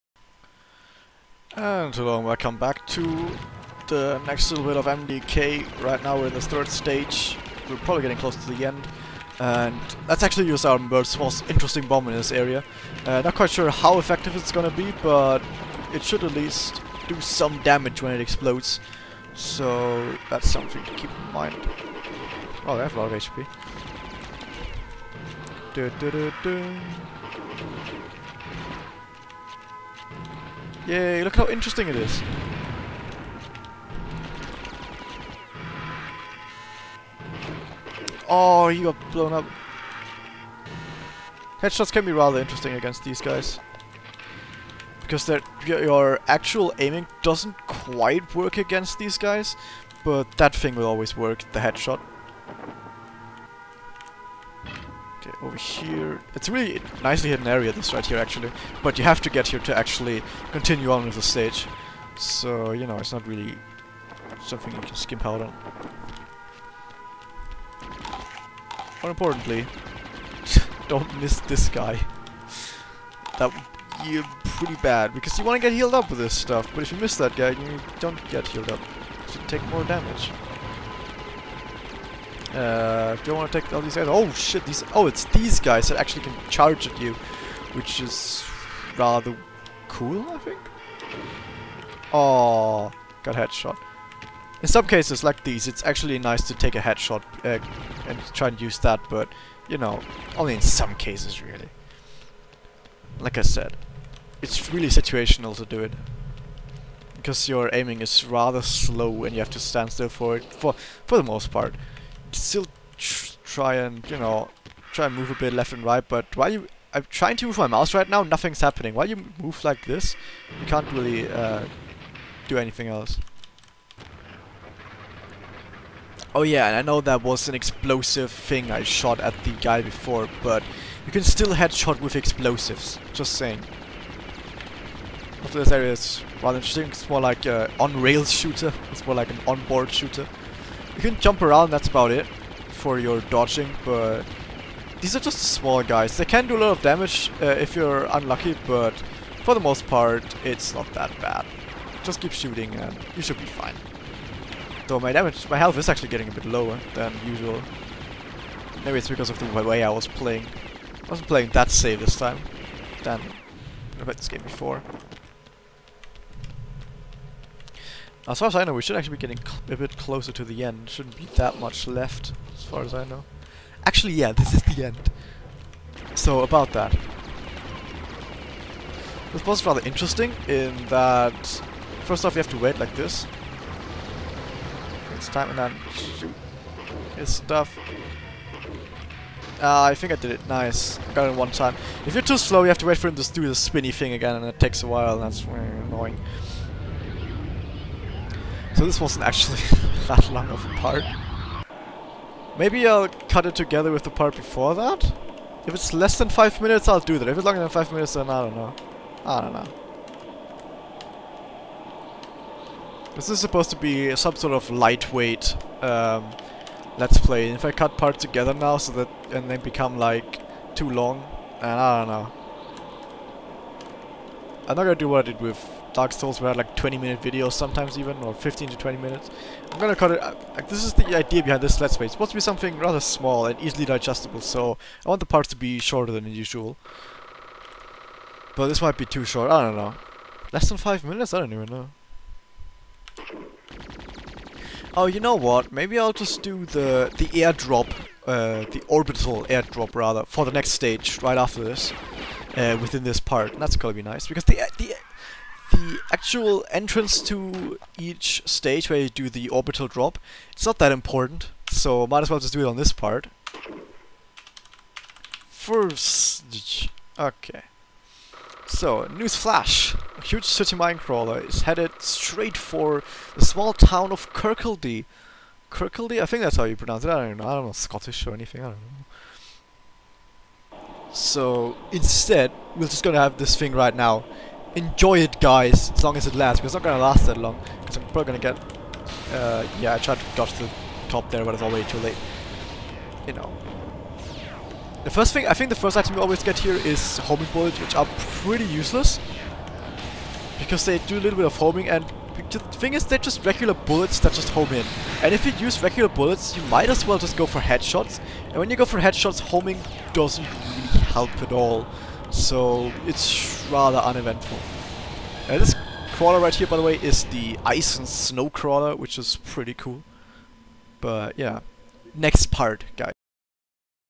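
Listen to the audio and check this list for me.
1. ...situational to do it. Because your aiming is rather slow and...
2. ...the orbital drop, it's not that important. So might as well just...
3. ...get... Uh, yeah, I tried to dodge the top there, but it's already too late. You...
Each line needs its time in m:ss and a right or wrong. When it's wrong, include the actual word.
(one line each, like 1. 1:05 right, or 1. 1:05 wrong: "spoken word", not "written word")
1. 1:44 right
2. 4:19 right
3. 4:48 right.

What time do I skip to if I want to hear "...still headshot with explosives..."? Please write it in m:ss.
2:11.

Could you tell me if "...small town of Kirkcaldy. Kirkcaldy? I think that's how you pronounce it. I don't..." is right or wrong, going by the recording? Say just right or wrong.
right.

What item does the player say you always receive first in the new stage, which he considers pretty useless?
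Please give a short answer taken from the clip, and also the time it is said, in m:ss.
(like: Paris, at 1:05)
homing bullets, at 4:57.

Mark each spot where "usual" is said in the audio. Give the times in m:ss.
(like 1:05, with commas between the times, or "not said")
2:37, 3:56.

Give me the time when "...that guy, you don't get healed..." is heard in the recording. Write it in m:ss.
1:17.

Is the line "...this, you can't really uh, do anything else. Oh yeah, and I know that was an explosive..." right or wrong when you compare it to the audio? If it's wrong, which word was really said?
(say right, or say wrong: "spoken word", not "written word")
right.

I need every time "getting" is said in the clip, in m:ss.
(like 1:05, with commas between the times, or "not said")
0:08, 2:36, 2:49.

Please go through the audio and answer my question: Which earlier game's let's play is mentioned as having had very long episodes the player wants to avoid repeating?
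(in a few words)
Dark Souls.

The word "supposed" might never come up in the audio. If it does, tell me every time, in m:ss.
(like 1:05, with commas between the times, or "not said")
3:33, 3:52.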